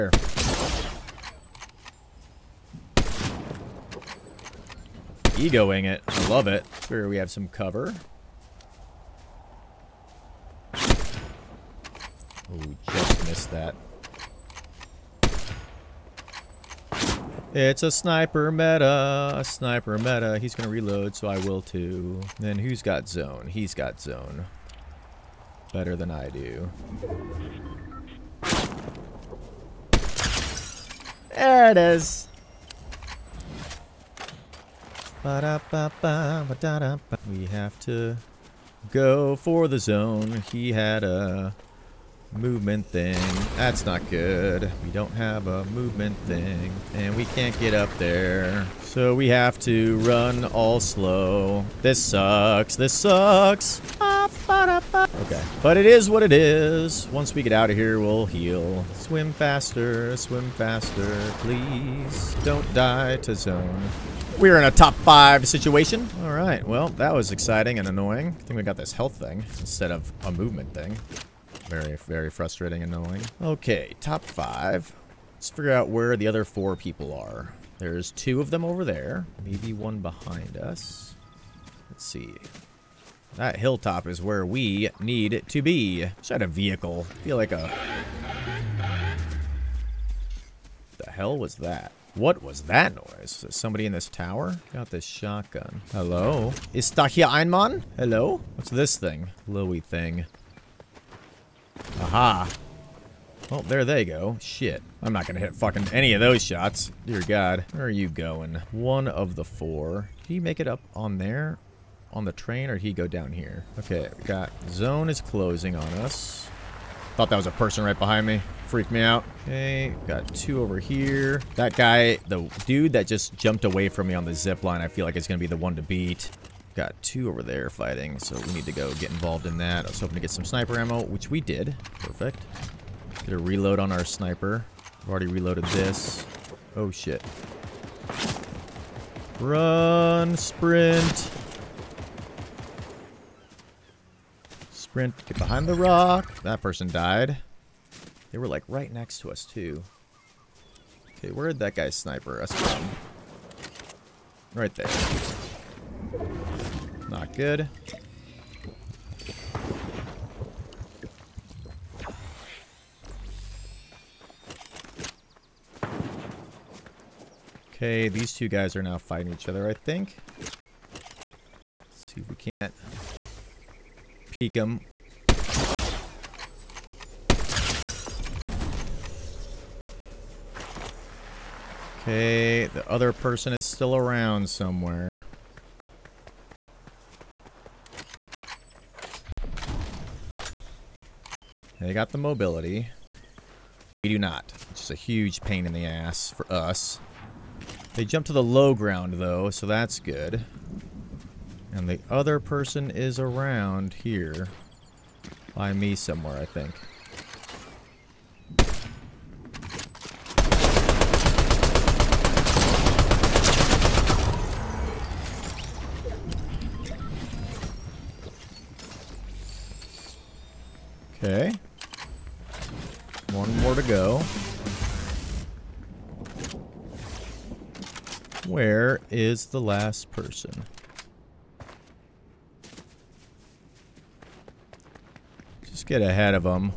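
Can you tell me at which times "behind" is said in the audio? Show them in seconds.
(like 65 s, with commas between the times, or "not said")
79 s, 117 s, 145 s.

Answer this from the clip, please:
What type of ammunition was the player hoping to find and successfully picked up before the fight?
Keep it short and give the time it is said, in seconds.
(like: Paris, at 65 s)
Sniper ammo, at 130 s.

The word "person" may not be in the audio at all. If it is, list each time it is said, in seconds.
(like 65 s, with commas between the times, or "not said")
117 s, 146 s, 183 s, 202 s, 230 s.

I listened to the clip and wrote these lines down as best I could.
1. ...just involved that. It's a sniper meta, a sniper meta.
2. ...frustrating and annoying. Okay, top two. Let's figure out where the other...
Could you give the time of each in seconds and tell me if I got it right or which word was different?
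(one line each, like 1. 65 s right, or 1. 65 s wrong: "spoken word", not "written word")
1. 12 s wrong: "missed", not "involved"
2. 72 s wrong: "five", not "two".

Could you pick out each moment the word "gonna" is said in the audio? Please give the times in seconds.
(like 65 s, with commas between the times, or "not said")
105 s, 125 s.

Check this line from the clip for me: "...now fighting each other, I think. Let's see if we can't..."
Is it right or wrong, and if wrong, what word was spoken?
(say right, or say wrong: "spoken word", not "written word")
right.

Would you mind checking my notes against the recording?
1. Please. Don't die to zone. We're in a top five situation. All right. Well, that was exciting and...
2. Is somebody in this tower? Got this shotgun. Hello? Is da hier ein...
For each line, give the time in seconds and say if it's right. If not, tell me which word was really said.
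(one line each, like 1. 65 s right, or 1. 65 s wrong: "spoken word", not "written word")
1. 61 s right
2. 93 s right.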